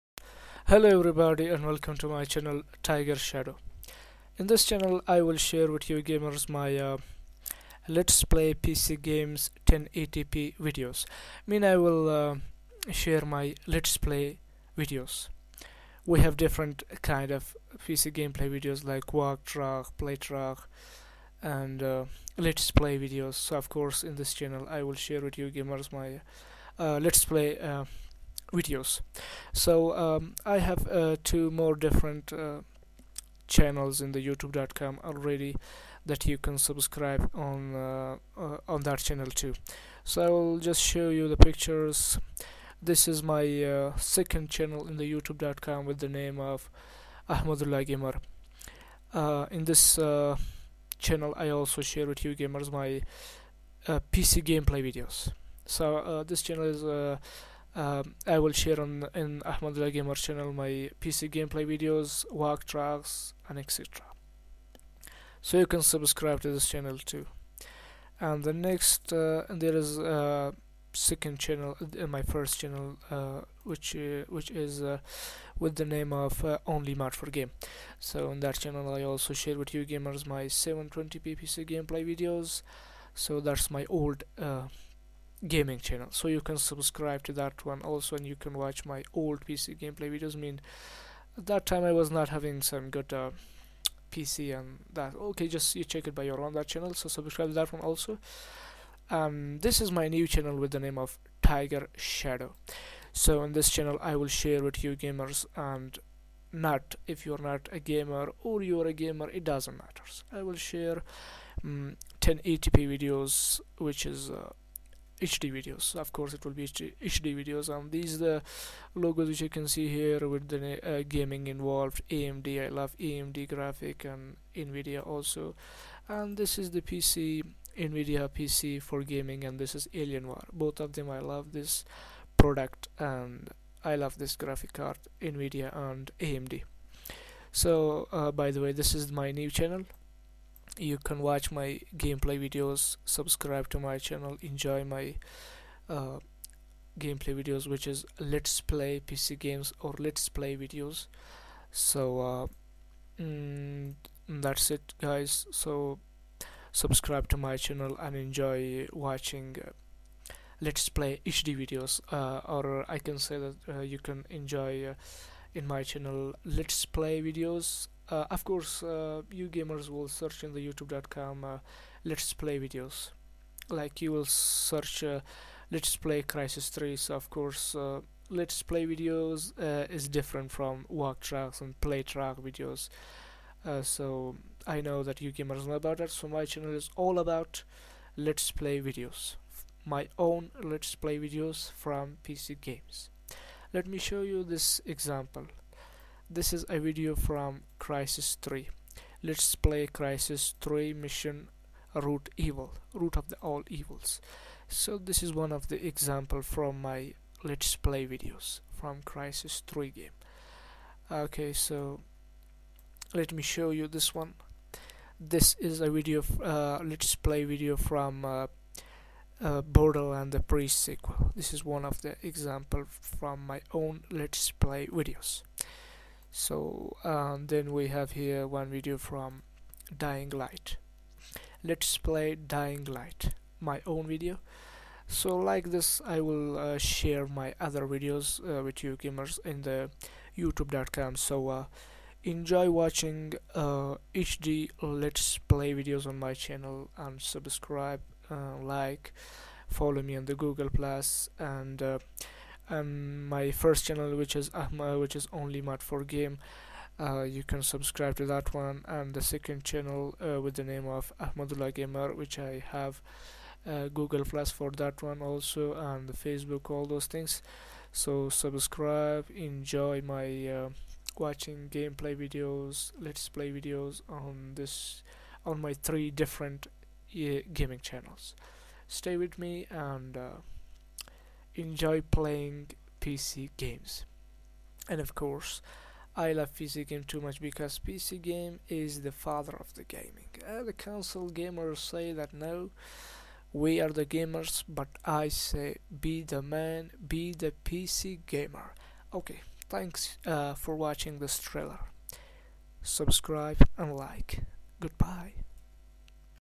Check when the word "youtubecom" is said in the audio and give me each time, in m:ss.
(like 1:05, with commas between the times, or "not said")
0:34, 0:45, 2:50, 4:00.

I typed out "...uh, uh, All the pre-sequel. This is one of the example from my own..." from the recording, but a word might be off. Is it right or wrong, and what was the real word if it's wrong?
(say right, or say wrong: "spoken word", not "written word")
wrong: "Borderland", not "All".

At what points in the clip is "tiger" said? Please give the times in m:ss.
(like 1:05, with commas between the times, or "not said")
0:02, 1:41.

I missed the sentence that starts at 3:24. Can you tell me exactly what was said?
So this is one of the example from my Let's Play videos from Crysis 3 game.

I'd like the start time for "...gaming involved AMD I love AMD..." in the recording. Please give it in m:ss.
2:01.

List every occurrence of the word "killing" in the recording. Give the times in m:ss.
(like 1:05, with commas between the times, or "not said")
not said.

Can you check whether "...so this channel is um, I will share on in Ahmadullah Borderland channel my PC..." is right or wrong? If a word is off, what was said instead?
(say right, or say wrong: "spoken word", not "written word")
wrong: "Gamer", not "Borderland".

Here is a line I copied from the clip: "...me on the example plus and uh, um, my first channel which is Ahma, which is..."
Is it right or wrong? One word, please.
wrong.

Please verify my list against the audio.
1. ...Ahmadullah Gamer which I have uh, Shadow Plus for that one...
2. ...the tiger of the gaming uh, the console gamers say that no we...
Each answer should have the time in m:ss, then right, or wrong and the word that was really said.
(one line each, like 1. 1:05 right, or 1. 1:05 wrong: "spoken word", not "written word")
1. 4:21 wrong: "Google", not "Shadow"
2. 4:49 wrong: "father", not "tiger".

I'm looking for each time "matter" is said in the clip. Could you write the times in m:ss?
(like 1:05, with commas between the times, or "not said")
1:49.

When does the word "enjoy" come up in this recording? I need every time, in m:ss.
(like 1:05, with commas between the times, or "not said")
2:24, 2:38, 2:44, 4:02, 4:29, 4:41.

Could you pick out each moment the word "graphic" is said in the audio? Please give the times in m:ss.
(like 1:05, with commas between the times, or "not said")
2:03, 2:14.